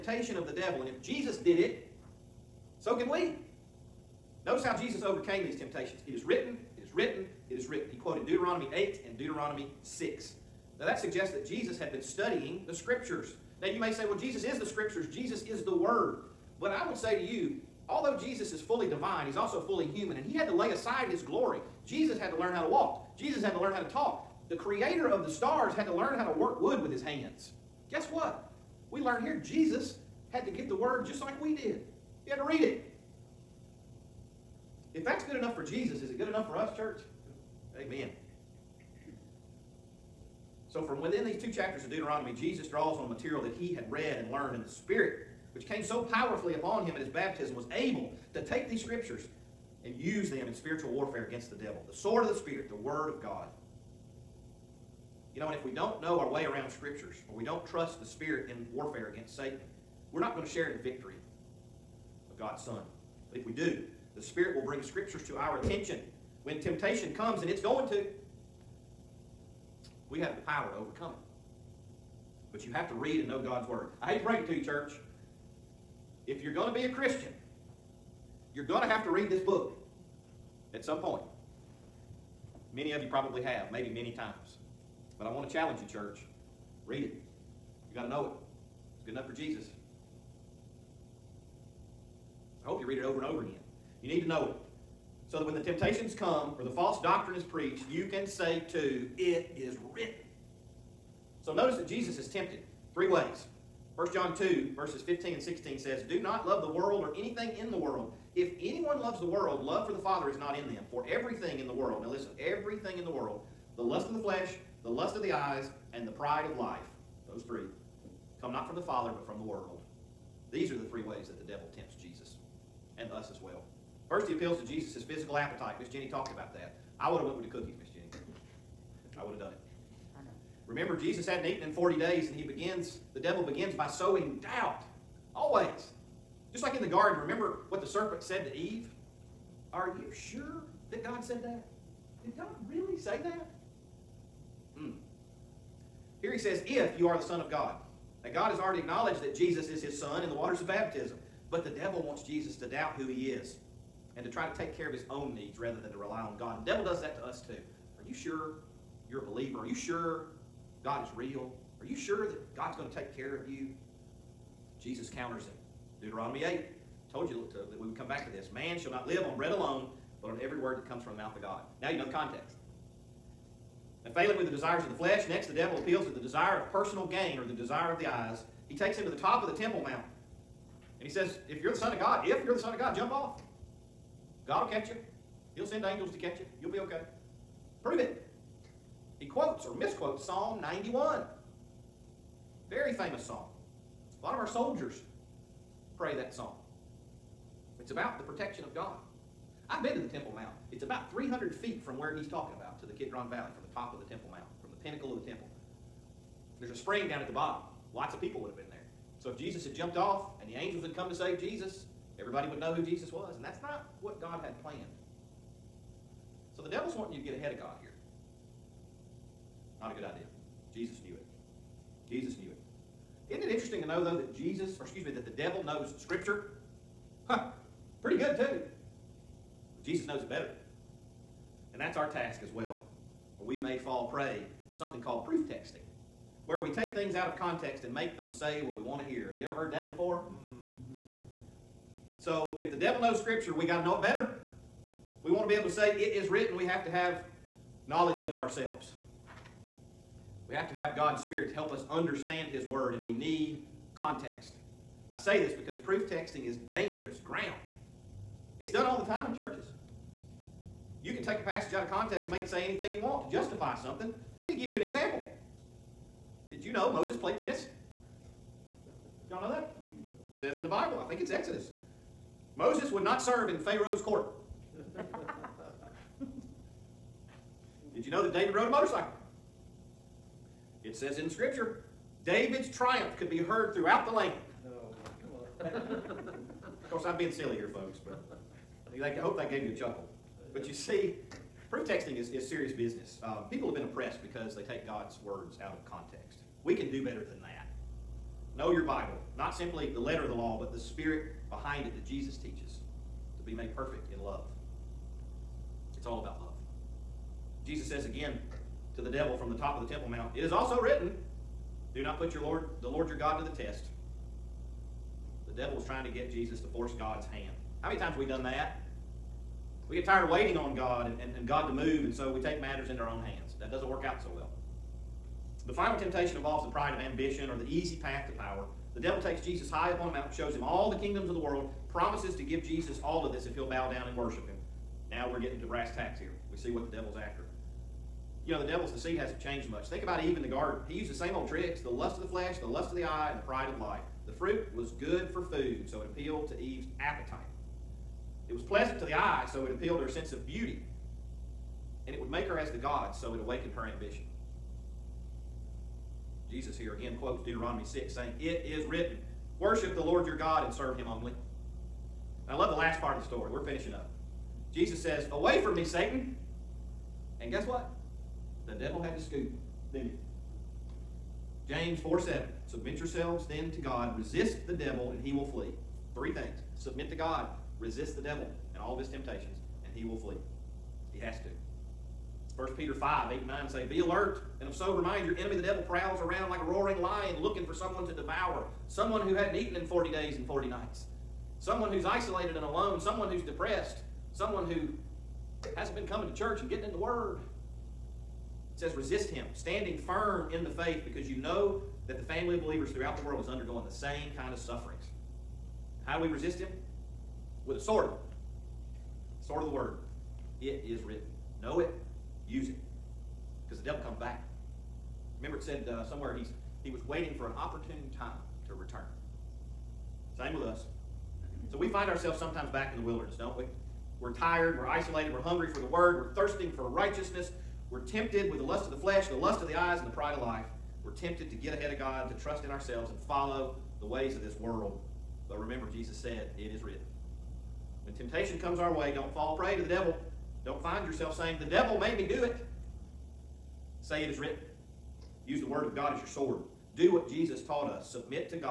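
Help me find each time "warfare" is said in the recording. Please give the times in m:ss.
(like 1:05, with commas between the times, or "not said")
0:50, 0:58.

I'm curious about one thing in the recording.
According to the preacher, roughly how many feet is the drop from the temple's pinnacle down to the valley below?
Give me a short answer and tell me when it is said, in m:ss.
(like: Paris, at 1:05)
300, at 3:21.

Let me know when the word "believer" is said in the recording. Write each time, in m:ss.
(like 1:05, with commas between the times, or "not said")
2:39, 6:42.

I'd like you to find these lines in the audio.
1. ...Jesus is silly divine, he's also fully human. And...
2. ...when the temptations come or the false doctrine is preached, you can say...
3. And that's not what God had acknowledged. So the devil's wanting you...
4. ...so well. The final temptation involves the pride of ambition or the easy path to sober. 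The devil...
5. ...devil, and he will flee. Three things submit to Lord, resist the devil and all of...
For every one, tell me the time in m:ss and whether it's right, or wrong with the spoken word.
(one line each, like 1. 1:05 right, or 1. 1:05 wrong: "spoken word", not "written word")
1. 0:18 wrong: "fully", not "silly"
2. 1:35 right
3. 3:33 wrong: "planned", not "acknowledged"
4. 5:24 wrong: "power", not "sober"
5. 6:14 wrong: "God", not "Lord".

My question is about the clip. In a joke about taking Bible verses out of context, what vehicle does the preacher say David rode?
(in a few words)
motorcycle.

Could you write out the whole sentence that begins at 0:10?
Now that suggests that Jesus had been studying the Scriptures.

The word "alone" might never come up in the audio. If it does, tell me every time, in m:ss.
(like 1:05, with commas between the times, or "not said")
2:49, 6:32.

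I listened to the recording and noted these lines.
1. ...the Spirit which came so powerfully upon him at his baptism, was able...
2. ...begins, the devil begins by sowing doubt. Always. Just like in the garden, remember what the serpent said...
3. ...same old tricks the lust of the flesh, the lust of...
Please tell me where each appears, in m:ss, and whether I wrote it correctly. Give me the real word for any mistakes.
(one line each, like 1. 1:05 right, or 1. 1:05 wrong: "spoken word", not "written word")
1. 0:44 right
2. 2:12 right
3. 5:41 right.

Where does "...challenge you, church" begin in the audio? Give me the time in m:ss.
1:25.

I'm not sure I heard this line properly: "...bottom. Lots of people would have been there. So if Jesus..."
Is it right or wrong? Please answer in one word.
right.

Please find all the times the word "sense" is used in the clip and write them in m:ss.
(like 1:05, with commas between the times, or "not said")
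5:50.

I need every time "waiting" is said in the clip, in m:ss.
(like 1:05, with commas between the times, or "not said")
5:20, 6:57.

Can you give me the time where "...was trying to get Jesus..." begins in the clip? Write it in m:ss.
5:15.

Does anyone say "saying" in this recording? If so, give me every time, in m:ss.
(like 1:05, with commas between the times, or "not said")
5:58, 7:21.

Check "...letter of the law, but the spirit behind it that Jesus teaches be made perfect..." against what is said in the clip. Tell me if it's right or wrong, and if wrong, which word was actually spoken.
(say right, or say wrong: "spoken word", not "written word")
right.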